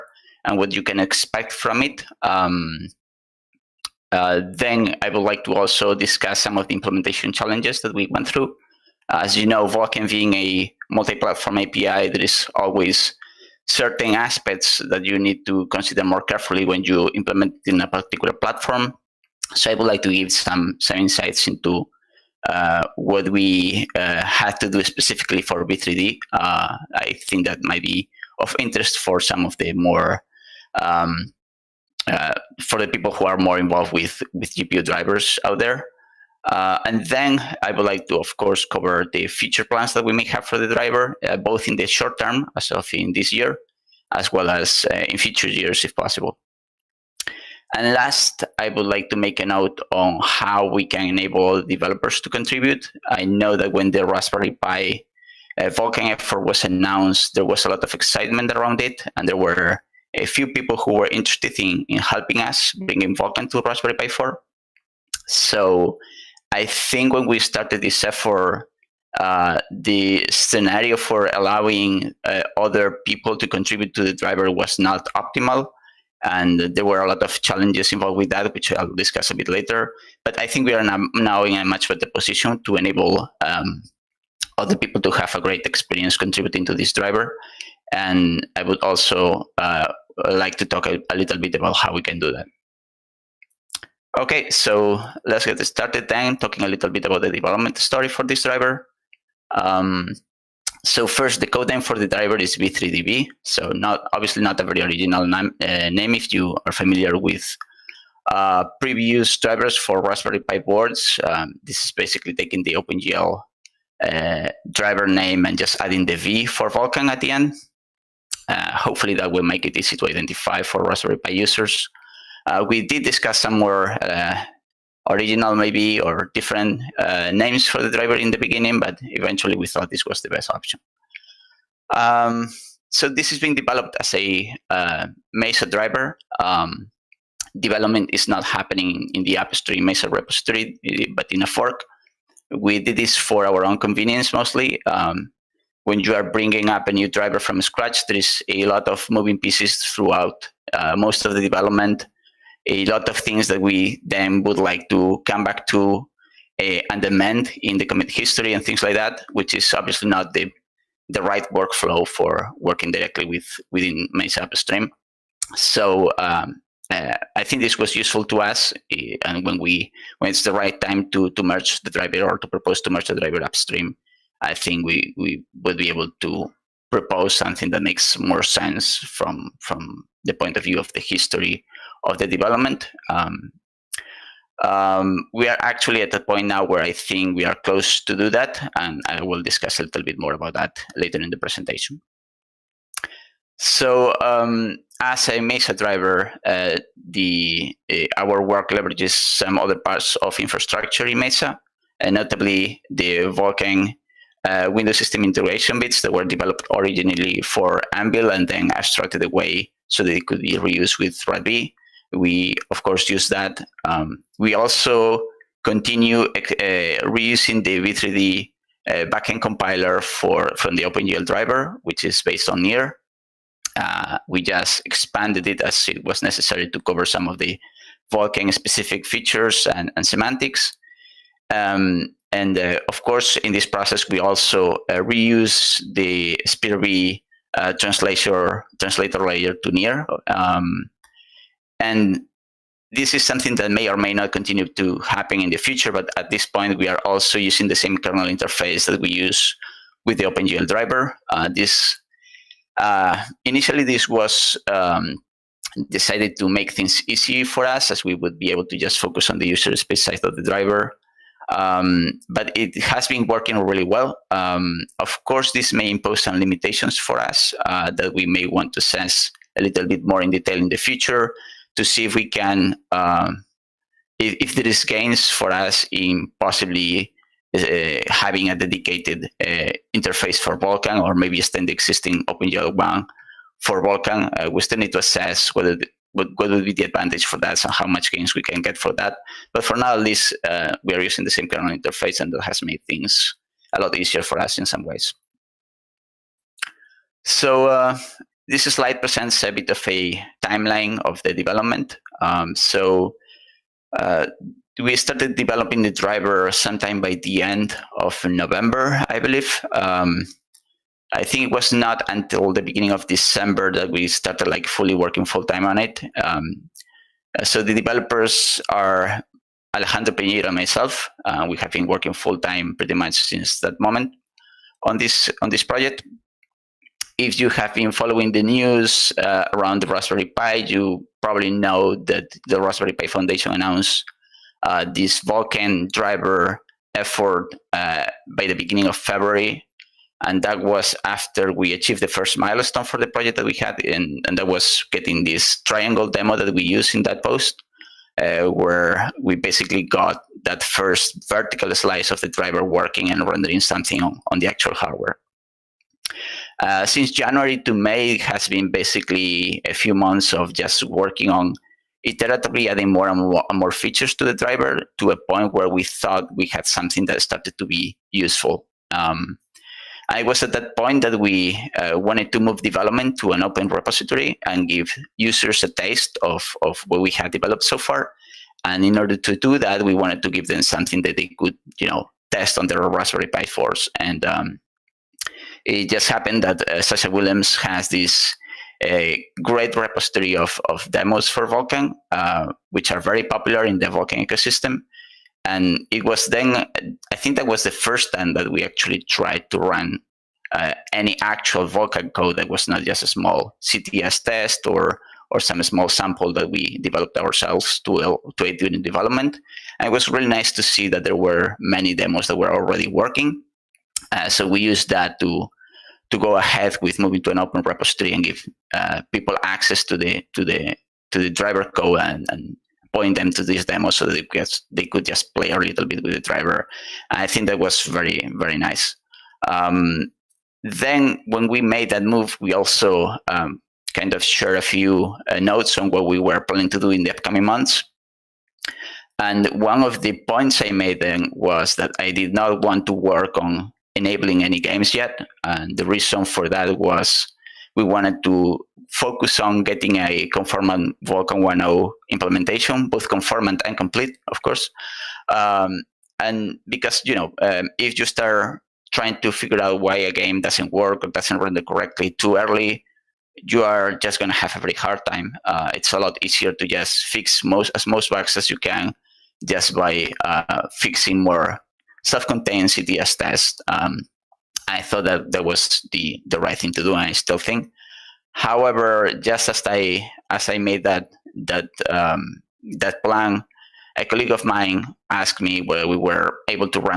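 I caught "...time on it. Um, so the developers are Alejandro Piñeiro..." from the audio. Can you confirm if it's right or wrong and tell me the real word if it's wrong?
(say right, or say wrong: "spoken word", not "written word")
right.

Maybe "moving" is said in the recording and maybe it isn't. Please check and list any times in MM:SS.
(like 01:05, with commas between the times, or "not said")
02:29, 06:56.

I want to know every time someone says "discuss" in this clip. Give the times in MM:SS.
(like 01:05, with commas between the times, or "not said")
00:05, 01:18, 02:03, 03:09.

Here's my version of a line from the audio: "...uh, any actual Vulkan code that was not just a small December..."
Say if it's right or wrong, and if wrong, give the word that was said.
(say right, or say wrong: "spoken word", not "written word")
wrong: "CTS", not "December".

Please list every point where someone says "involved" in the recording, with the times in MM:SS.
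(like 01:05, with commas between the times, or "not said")
00:33, 01:17.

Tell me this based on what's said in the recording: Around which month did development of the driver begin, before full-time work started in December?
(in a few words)
November.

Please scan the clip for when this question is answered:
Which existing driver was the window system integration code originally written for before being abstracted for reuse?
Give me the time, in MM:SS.
03:27.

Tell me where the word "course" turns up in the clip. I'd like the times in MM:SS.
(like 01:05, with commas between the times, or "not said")
00:38, 03:32, 03:53, 04:25, 07:34.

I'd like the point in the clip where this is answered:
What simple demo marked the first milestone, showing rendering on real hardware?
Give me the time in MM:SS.
05:45.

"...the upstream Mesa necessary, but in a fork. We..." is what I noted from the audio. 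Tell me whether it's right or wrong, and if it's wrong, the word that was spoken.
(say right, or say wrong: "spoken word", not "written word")
wrong: "repository", not "necessary".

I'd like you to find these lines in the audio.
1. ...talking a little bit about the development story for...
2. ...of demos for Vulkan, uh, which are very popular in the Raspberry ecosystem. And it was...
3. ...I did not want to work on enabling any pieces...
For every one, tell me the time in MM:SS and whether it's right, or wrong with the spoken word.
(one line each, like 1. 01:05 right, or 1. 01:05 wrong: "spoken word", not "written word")
1. 01:36 right
2. 06:30 wrong: "Vulkan", not "Raspberry"
3. 07:21 wrong: "games", not "pieces".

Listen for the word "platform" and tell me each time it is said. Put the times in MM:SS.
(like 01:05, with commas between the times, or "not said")
00:10, 00:18.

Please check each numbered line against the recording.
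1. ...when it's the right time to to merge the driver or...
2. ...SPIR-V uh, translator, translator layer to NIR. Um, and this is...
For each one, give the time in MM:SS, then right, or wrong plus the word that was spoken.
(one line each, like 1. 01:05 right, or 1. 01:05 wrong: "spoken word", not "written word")
1. 02:50 right
2. 03:56 right.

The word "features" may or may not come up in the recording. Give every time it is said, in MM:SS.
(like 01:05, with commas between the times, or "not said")
03:49, 06:03.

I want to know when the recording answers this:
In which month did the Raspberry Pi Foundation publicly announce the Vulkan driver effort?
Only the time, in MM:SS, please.
05:38.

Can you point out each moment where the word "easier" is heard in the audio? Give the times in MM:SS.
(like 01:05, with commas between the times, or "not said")
04:53, 07:46.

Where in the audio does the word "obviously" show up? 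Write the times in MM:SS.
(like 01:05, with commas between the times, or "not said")
01:44, 02:39.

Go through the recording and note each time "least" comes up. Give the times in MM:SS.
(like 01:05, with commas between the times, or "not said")
04:49.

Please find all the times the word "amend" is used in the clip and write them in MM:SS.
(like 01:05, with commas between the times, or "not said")
02:37.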